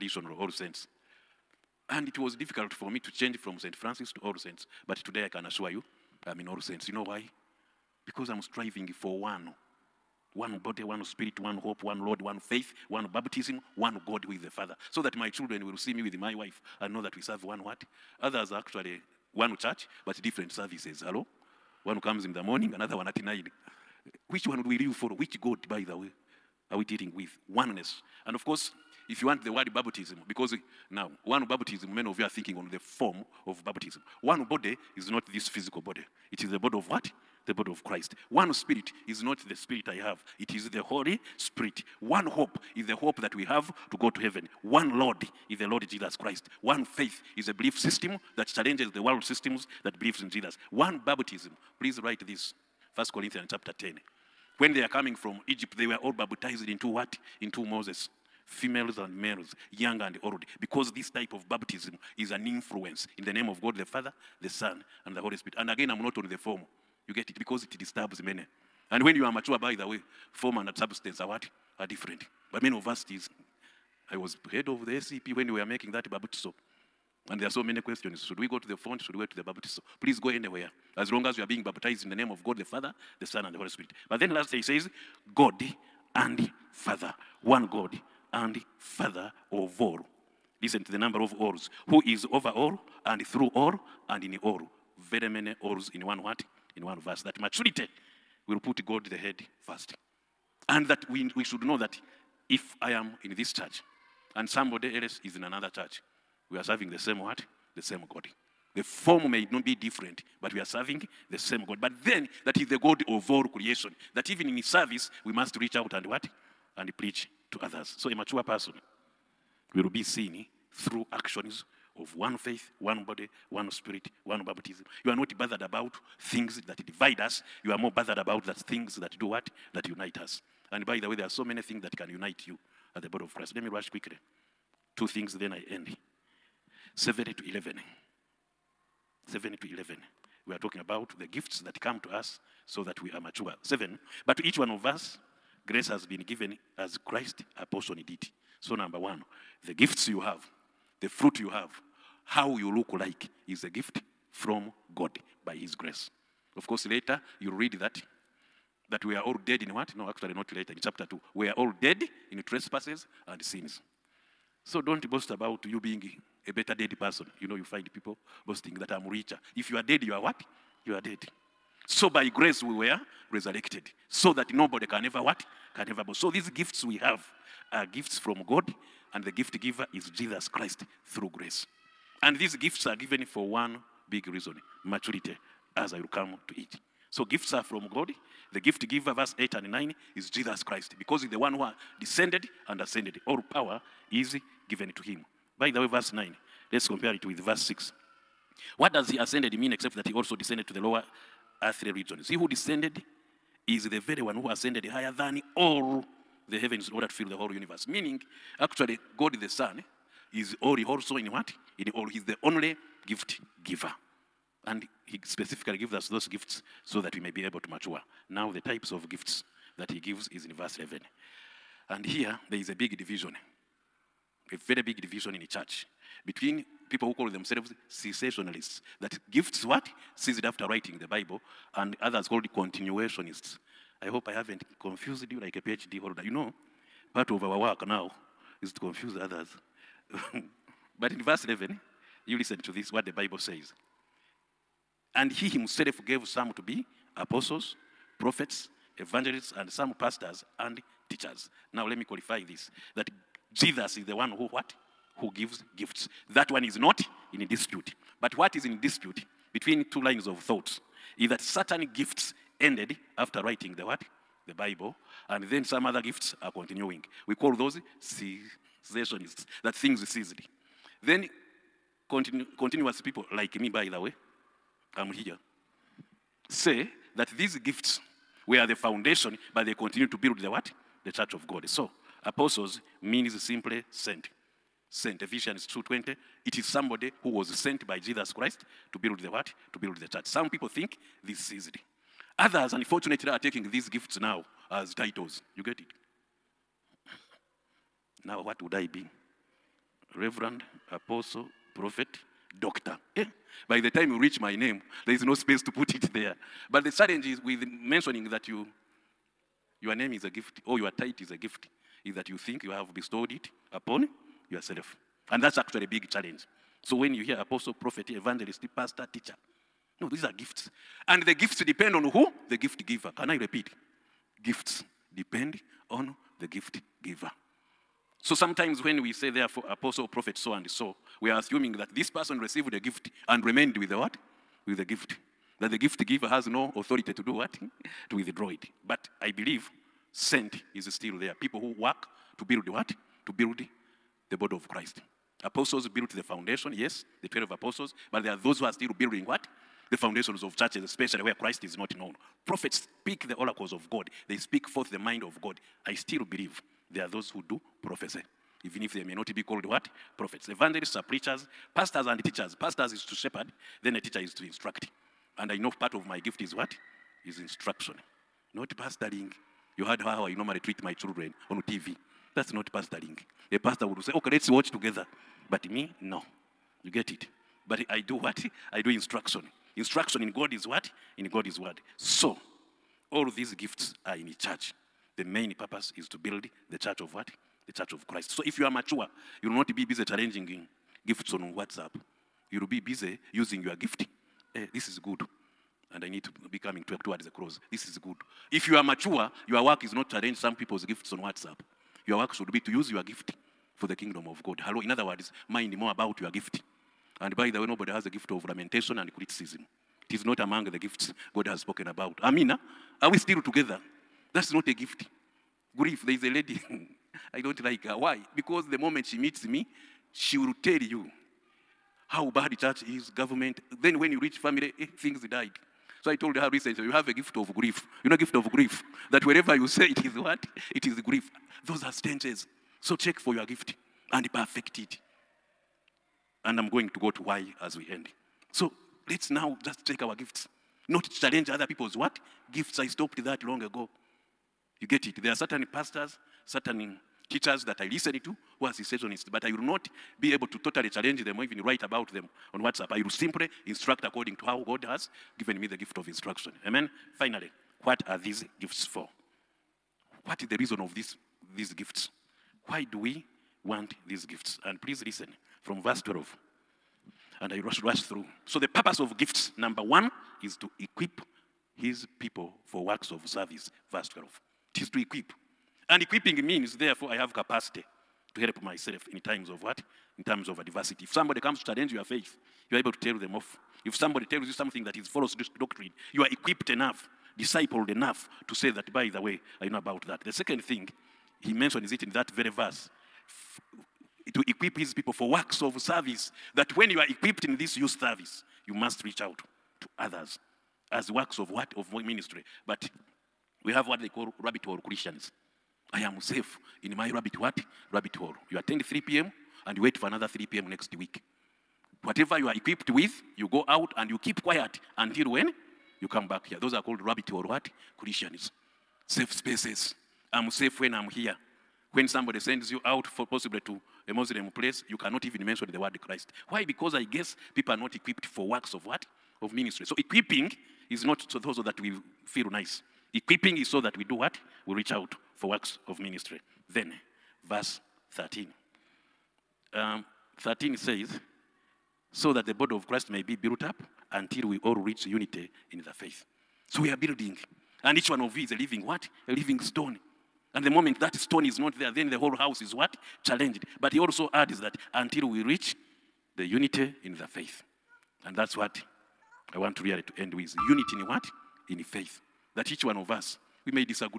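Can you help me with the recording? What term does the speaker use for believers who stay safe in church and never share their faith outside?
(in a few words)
rabbit hole Christians.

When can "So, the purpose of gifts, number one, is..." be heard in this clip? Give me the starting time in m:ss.
7:48.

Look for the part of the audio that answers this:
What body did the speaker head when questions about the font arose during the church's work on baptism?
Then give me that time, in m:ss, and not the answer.
1:14.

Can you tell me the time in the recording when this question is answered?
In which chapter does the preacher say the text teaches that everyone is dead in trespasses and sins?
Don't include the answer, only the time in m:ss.
2:40.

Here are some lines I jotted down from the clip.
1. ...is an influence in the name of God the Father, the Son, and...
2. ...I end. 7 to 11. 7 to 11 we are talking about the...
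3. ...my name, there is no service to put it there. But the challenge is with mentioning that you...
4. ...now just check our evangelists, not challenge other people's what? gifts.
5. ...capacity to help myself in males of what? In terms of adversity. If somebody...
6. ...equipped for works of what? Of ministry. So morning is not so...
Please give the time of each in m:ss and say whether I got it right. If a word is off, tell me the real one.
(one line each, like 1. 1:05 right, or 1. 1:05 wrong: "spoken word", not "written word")
1. 1:02 right
2. 2:15 right
3. 5:04 wrong: "space", not "service"
4. 7:19 wrong: "gifts", not "evangelists"
5. 7:57 wrong: "times", not "males"
6. 8:47 wrong: "equipping", not "morning".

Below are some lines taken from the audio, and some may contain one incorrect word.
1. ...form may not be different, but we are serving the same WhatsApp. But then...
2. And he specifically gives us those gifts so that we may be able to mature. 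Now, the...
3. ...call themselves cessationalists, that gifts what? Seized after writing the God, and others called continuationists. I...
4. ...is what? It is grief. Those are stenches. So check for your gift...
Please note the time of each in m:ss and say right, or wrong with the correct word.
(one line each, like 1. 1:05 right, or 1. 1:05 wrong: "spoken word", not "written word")
1. 1:48 wrong: "God", not "WhatsApp"
2. 3:34 right
3. 3:47 wrong: "Bible", not "God"
4. 7:10 right.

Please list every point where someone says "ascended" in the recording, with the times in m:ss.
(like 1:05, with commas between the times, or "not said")
3:12, 3:19, 3:24.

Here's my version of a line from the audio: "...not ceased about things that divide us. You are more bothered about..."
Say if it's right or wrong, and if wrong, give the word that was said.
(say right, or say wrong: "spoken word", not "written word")
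wrong: "bothered", not "ceased".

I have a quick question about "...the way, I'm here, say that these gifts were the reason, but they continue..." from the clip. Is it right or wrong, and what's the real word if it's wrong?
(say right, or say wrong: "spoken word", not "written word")
wrong: "foundation", not "reason".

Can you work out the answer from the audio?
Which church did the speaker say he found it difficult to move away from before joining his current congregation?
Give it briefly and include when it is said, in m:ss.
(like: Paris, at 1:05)
St. Francis, at 0:03.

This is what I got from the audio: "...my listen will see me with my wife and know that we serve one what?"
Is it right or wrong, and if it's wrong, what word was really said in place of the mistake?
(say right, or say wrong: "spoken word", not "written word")
wrong: "children", not "listen".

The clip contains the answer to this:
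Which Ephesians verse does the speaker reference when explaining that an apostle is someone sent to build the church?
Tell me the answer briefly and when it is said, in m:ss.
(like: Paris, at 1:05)
Ephesians 2:20, at 4:45.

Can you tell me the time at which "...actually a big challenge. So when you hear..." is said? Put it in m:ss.
5:15.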